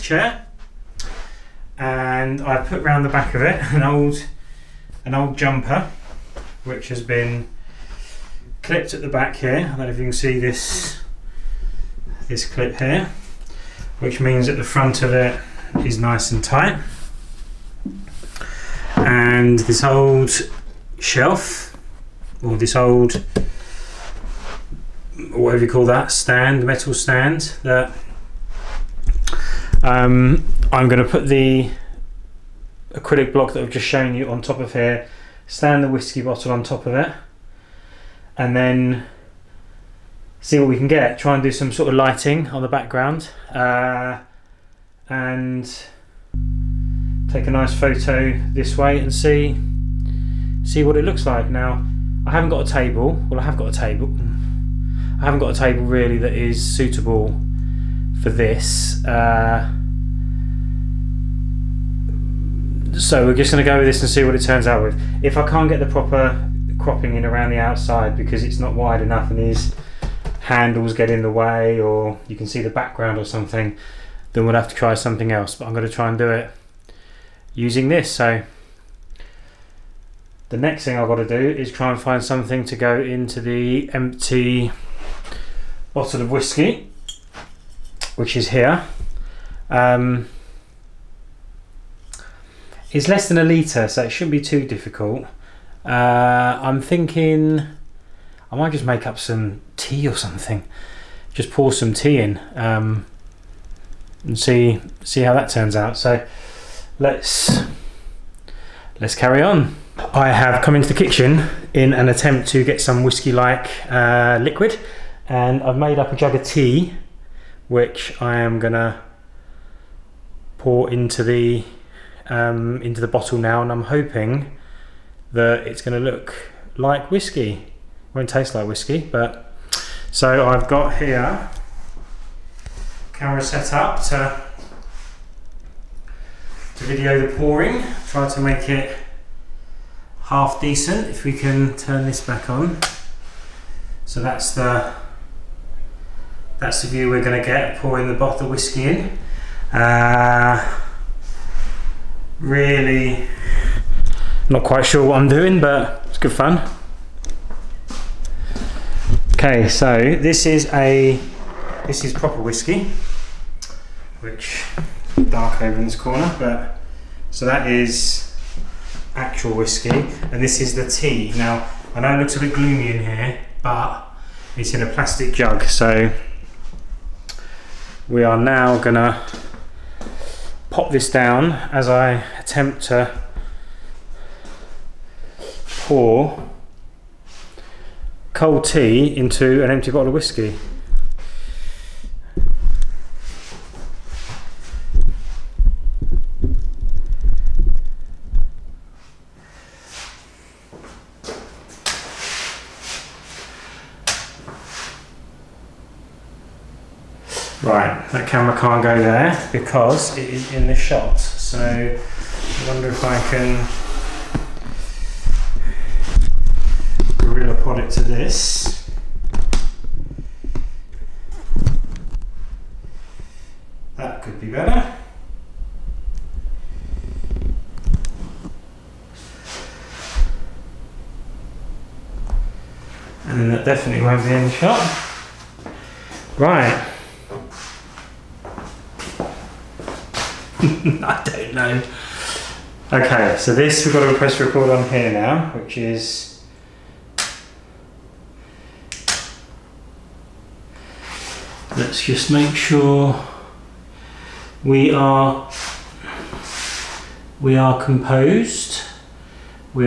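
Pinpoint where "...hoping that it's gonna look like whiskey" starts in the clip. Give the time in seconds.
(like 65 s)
123 s.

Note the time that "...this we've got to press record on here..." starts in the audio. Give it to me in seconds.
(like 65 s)
243 s.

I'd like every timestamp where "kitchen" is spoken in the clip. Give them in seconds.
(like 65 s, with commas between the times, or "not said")
110 s.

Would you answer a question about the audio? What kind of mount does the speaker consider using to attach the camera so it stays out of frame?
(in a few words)
gorilla pod.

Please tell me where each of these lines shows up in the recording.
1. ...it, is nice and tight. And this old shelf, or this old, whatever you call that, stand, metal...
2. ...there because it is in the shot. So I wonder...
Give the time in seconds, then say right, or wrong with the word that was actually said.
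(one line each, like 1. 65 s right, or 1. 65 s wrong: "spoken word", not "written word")
1. 15 s right
2. 209 s right.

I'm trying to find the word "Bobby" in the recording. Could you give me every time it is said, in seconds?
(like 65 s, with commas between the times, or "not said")
not said.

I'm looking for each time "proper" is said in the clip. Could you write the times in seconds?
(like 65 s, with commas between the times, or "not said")
65 s, 162 s.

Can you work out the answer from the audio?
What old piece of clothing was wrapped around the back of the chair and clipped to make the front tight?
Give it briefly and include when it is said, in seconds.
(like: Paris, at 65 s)
jumper, at 5 s.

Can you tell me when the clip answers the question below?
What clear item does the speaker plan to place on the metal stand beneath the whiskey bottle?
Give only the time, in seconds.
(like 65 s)
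32 s.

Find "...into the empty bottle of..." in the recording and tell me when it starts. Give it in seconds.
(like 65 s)
83 s.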